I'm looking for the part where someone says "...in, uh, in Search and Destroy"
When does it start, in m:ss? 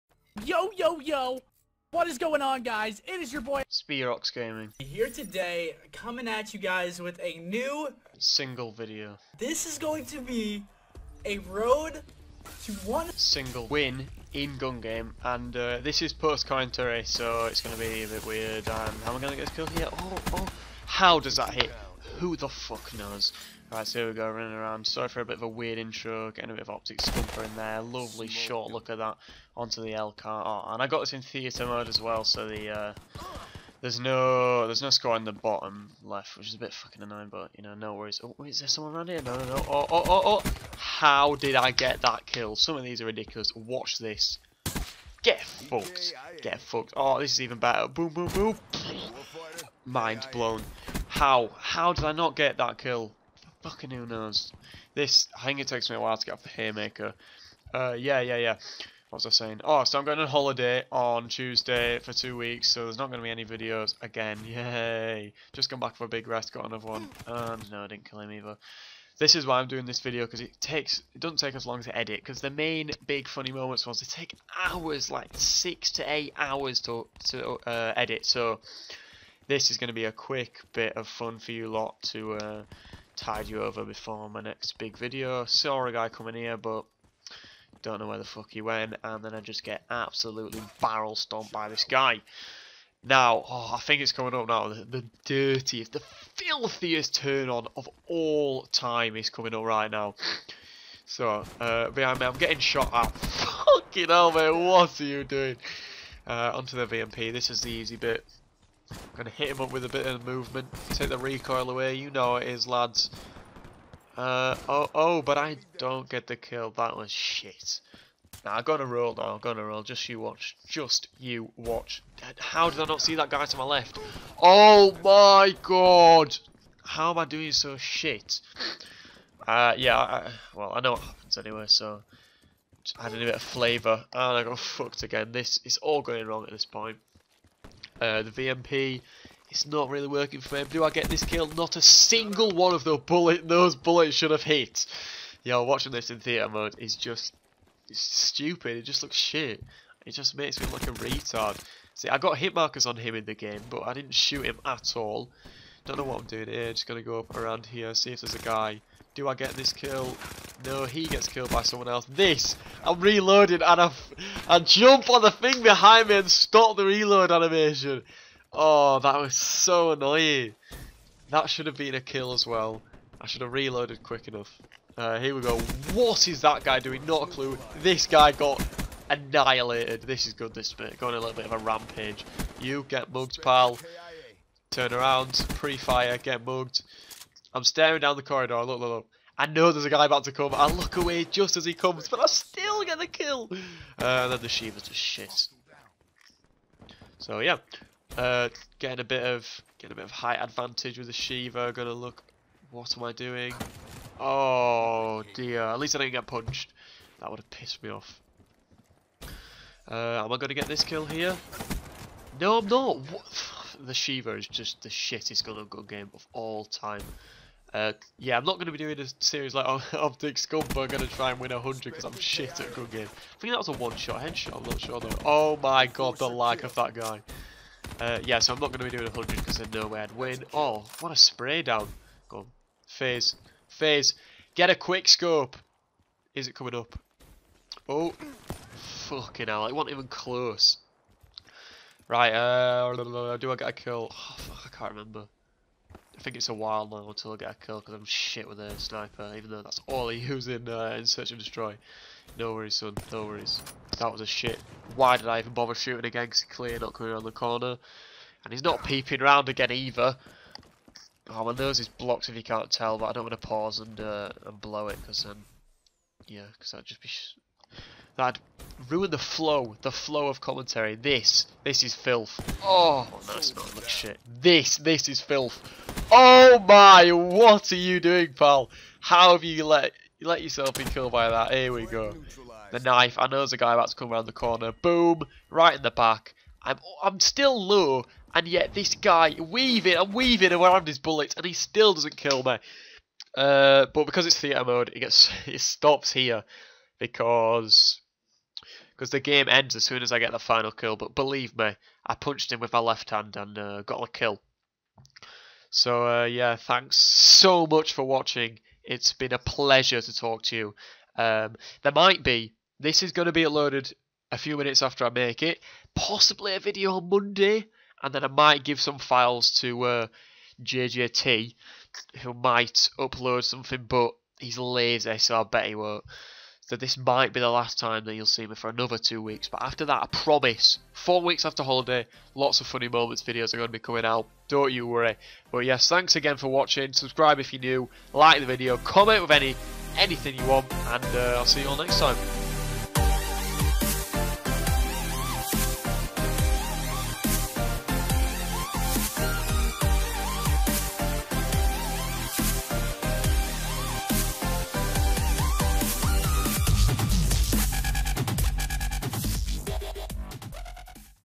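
4:10.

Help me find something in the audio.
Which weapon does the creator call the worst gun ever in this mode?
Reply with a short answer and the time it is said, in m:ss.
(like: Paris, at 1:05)
Shiva, at 3:33.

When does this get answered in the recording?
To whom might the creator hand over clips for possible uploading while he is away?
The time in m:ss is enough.
5:20.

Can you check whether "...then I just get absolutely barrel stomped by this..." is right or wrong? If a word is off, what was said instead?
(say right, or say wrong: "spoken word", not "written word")
right.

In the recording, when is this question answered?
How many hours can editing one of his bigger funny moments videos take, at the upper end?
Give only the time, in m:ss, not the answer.
1:16.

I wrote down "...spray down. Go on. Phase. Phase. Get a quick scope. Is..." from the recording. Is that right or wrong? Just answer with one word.
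right.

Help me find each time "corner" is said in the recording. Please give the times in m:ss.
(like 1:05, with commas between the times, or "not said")
4:17, 4:44.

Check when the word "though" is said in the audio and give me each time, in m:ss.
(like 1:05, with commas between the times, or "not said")
1:59, 3:44, 4:09.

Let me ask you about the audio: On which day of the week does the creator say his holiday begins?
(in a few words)
Tuesday.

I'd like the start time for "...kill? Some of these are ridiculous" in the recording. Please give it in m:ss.
0:42.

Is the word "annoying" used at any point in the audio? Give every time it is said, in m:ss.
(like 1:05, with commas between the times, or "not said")
0:37, 2:49.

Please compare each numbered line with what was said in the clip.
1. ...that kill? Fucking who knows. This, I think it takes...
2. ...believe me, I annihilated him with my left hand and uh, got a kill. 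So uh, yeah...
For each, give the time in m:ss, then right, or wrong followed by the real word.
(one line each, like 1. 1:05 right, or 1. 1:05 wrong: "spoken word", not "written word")
1. 0:52 right
2. 5:01 wrong: "punched", not "annihilated".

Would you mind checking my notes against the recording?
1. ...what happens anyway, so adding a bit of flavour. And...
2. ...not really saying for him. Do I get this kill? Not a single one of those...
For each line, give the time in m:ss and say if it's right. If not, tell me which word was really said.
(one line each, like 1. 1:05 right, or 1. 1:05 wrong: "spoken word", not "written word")
1. 2:10 right
2. 2:19 wrong: "working", not "saying".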